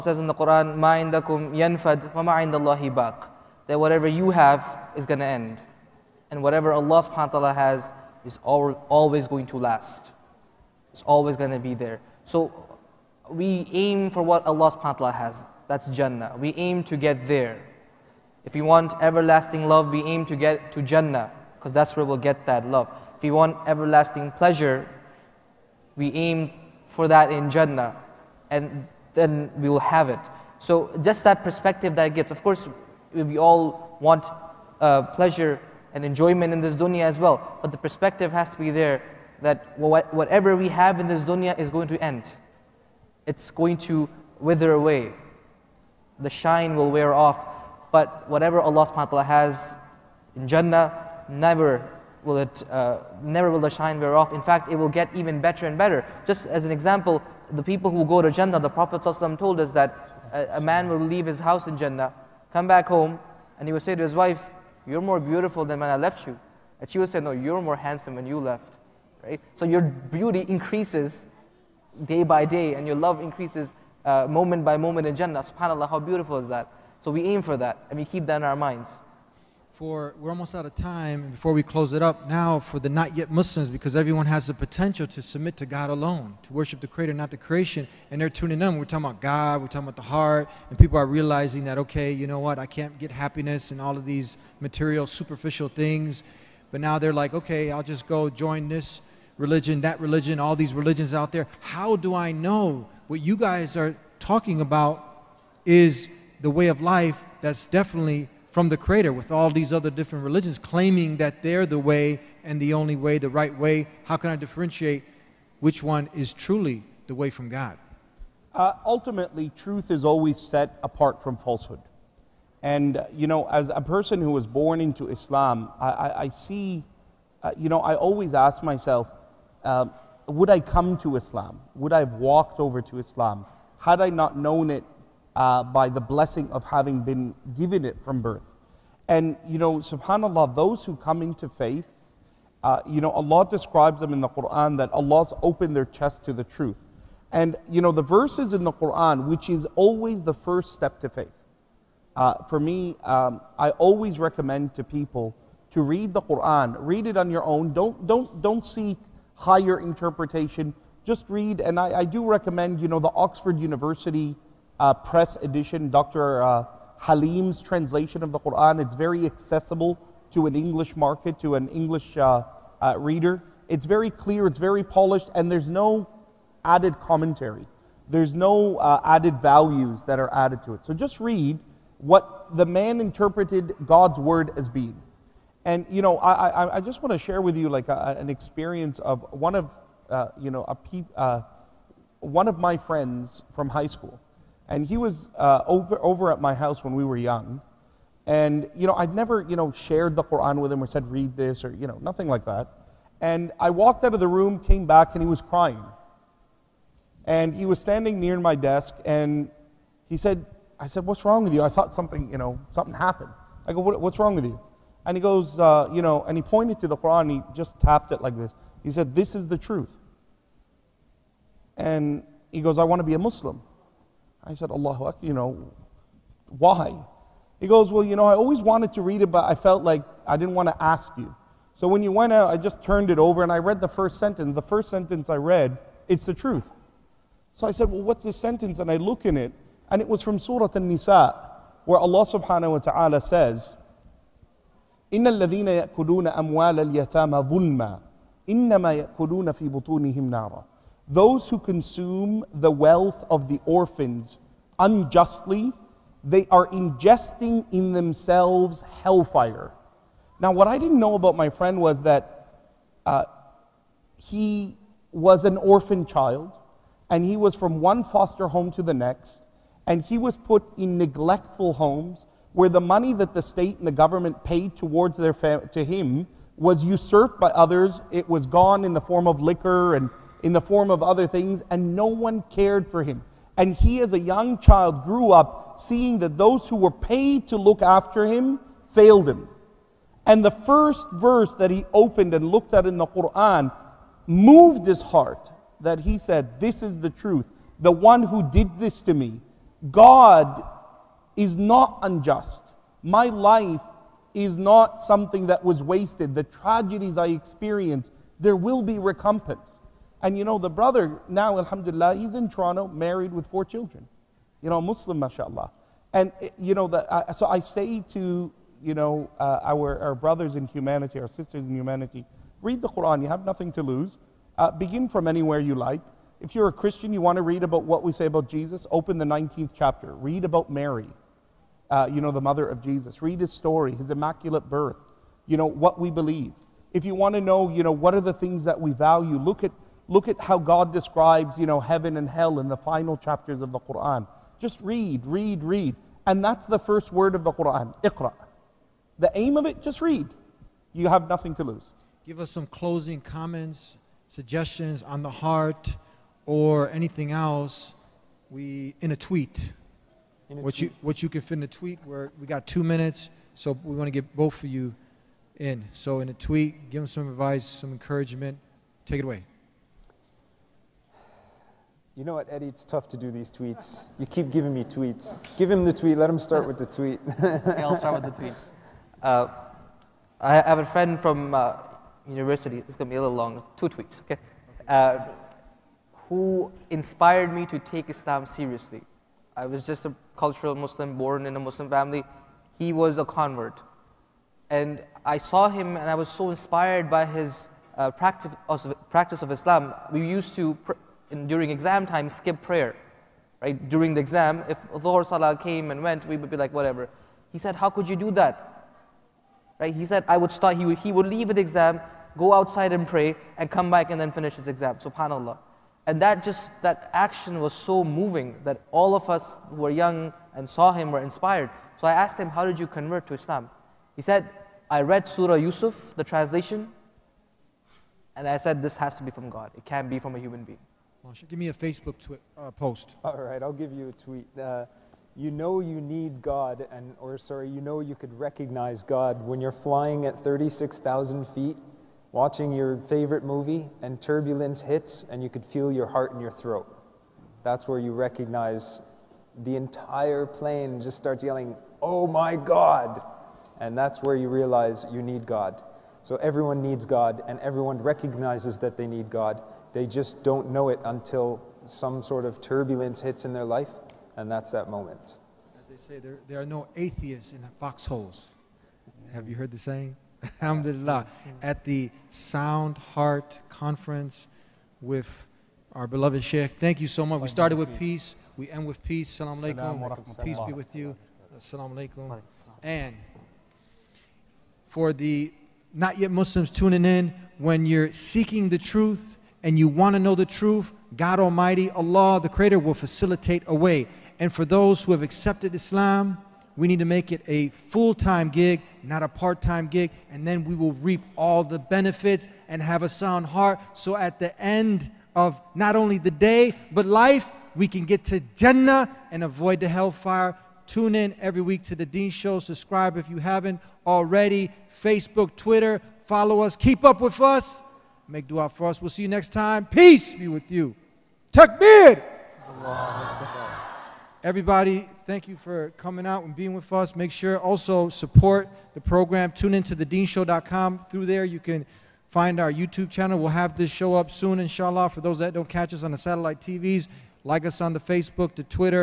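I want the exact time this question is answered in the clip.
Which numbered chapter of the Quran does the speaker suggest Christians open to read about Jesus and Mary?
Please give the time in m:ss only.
5:29.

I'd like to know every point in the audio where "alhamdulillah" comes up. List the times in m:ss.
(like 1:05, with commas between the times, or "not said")
5:11, 7:50.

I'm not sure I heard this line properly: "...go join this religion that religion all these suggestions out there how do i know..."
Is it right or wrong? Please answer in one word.
wrong.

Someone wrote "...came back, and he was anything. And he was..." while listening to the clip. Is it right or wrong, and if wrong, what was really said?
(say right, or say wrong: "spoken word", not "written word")
wrong: "crying", not "anything".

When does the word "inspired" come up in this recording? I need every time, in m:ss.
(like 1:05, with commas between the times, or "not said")
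6:26, 6:36, 7:01.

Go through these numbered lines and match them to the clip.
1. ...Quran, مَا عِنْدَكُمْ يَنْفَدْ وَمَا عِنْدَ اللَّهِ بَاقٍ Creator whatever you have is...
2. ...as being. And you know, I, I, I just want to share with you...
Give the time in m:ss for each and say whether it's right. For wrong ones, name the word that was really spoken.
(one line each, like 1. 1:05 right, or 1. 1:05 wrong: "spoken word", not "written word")
1. 0:00 wrong: "That", not "Creator"
2. 3:04 right.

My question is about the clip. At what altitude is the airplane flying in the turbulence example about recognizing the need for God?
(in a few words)
36,000 feet.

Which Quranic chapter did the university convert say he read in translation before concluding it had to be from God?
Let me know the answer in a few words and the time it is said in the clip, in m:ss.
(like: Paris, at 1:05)
Surah Yusuf, at 7:05.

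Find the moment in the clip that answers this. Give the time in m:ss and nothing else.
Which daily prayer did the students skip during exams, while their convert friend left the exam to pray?
6:44.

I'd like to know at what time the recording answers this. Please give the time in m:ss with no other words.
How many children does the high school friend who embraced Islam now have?
5:13.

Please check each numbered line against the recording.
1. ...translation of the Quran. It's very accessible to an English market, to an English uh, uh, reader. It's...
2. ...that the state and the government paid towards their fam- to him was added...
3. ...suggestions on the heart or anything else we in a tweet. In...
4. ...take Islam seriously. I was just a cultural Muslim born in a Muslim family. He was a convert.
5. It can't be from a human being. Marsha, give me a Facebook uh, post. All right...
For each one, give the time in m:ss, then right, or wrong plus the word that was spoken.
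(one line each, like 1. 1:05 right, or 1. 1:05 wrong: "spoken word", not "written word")
1. 2:47 right
2. 4:33 wrong: "usurped", not "added"
3. 5:54 right
4. 6:27 right
5. 7:09 right.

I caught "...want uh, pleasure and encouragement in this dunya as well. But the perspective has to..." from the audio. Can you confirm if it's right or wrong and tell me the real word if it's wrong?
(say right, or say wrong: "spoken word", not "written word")
wrong: "enjoyment", not "encouragement".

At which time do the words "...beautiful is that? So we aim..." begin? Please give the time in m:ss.
1:15.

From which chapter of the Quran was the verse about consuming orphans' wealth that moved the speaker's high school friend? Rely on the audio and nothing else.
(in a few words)
Surah Al Nisa.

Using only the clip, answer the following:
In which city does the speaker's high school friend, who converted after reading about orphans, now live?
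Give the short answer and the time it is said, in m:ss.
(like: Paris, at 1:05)
Toronto, at 5:12.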